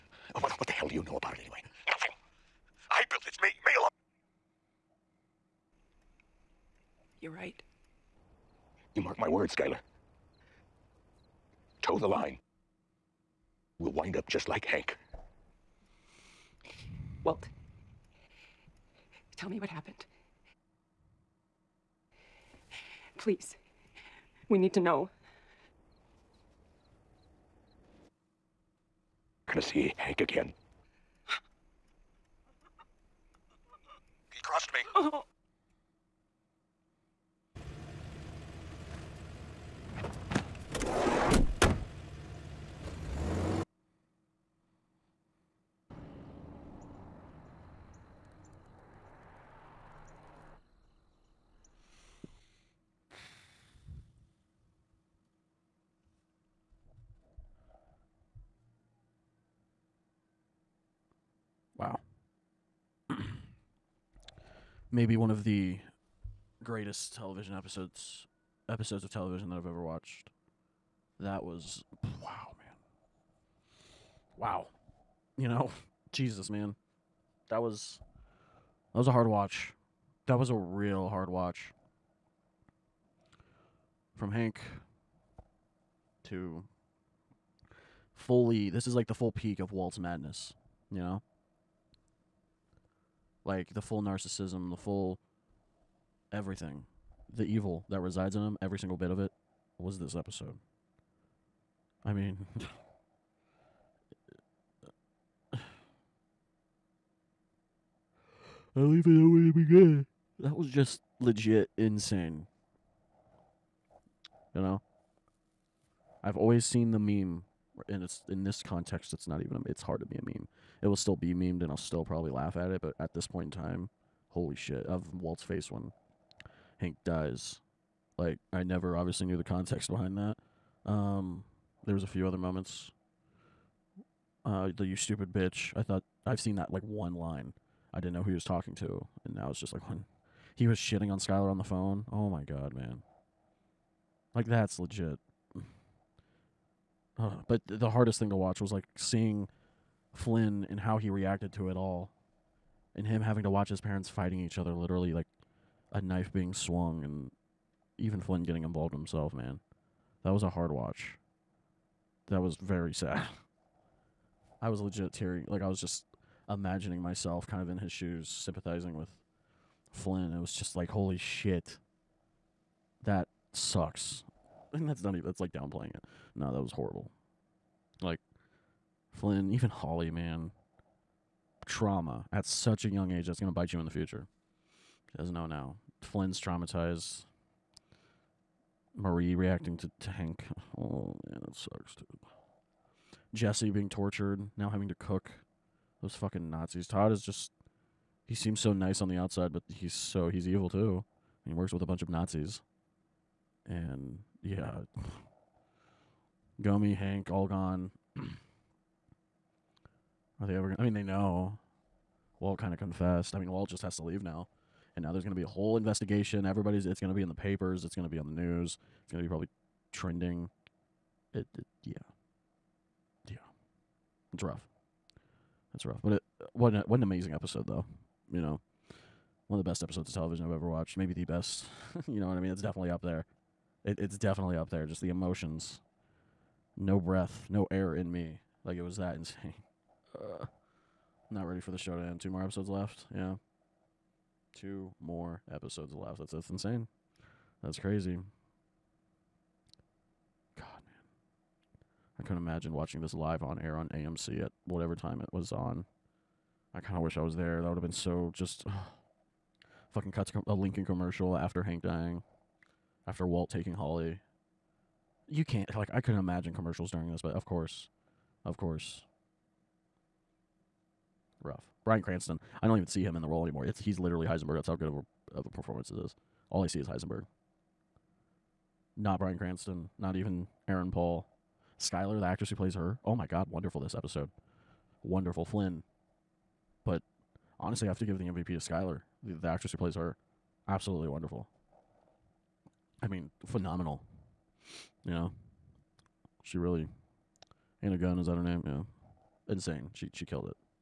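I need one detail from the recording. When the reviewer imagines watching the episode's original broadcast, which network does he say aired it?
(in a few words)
AMC.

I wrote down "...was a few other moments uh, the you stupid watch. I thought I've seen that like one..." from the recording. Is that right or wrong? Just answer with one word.
wrong.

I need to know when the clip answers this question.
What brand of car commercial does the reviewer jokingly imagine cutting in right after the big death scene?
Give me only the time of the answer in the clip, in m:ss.
4:20.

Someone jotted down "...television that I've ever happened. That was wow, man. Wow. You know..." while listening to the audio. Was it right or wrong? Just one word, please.
wrong.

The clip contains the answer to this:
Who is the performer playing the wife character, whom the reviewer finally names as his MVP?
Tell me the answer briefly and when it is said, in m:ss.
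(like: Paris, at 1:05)
Anna Gunn, at 4:57.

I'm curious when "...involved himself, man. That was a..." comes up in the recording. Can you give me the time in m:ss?
2:38.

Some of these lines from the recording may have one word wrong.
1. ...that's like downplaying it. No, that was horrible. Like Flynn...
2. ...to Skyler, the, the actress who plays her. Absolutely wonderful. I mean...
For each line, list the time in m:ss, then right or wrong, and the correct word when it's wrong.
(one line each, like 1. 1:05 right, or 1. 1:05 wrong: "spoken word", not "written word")
1. 2:55 right
2. 4:48 right.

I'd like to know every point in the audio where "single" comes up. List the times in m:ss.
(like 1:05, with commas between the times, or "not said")
1:38.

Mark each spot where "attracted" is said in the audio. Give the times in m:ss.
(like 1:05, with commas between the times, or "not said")
not said.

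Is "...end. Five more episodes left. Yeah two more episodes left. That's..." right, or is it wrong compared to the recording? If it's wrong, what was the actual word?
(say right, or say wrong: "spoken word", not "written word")
wrong: "Two", not "Five".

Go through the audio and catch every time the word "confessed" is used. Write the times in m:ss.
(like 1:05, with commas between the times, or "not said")
3:32.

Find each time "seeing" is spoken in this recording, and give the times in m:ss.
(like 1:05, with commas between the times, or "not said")
2:28.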